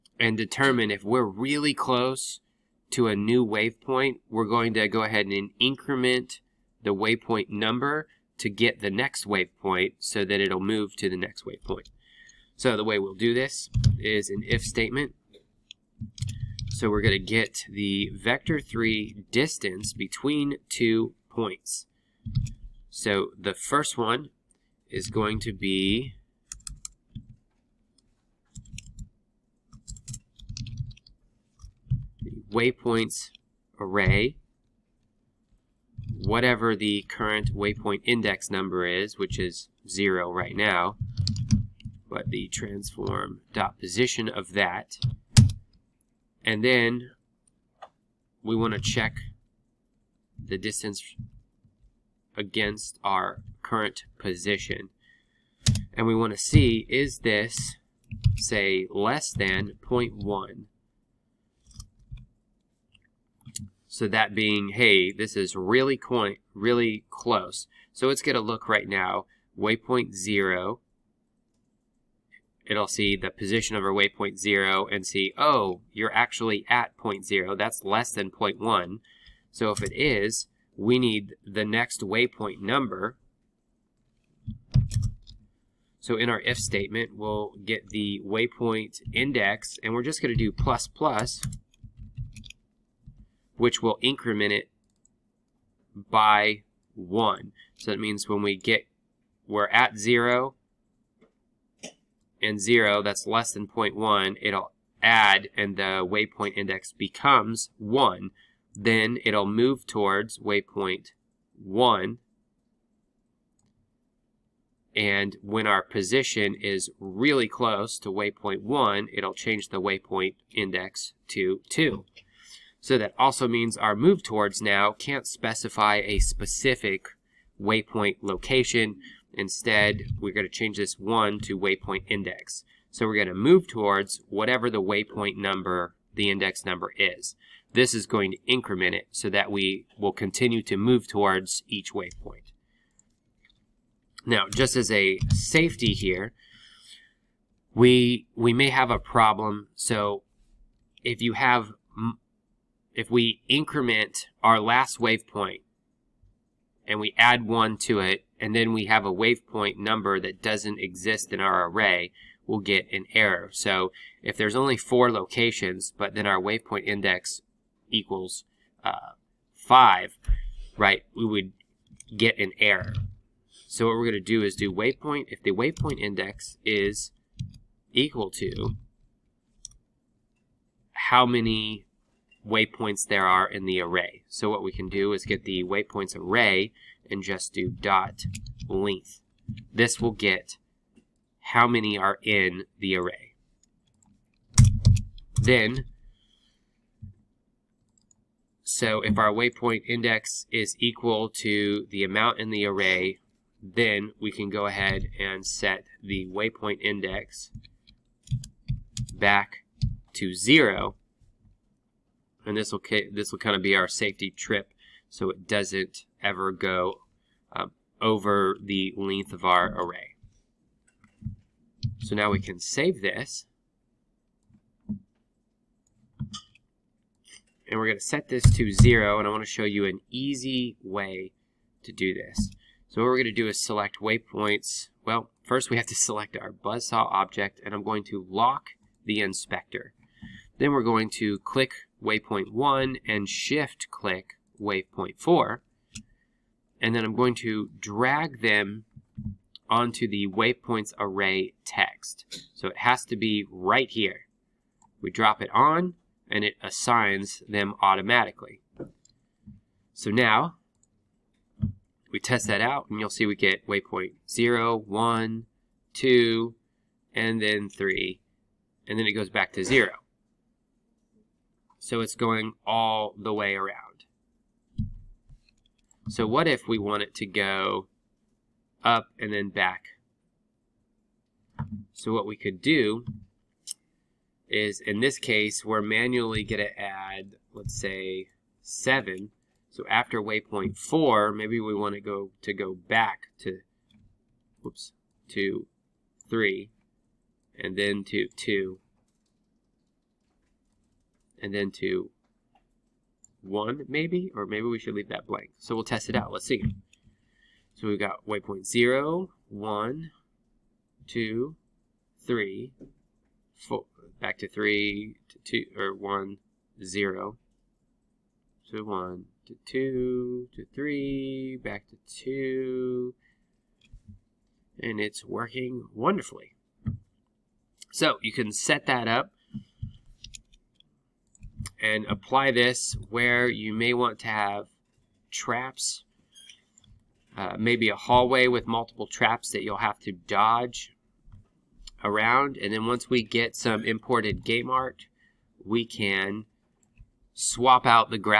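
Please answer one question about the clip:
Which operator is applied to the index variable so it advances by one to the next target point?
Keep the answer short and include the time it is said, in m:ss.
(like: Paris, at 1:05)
plus plus, at 1:30.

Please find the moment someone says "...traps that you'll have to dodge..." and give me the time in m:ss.
5:39.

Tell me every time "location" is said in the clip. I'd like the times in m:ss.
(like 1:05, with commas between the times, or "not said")
2:08, 2:45.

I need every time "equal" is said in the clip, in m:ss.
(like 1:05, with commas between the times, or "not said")
2:47, 2:57, 3:20.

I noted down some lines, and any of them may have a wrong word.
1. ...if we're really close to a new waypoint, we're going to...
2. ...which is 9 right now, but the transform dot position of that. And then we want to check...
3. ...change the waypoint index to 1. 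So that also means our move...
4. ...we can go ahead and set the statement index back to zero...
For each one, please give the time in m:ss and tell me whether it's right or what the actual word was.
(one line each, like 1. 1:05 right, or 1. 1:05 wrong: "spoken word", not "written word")
1. 0:00 right
2. 0:39 wrong: "0", not "9"
3. 1:59 wrong: "2", not "1"
4. 3:24 wrong: "waypoint", not "statement".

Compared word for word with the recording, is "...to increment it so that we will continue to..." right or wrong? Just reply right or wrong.
right.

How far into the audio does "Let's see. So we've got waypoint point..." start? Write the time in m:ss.
5:06.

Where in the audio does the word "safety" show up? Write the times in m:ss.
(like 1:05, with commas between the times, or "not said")
2:25, 3:33.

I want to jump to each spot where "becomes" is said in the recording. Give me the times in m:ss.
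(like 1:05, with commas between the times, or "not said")
1:46.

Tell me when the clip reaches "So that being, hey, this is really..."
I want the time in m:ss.
1:03.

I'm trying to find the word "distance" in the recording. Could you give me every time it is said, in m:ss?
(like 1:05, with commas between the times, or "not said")
0:19, 0:50.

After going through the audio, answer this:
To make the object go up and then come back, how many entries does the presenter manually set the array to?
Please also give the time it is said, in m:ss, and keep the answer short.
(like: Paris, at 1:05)
7, at 4:48.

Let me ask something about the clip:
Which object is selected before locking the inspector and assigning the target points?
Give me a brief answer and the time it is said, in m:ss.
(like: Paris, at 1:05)
buzzsaw, at 3:56.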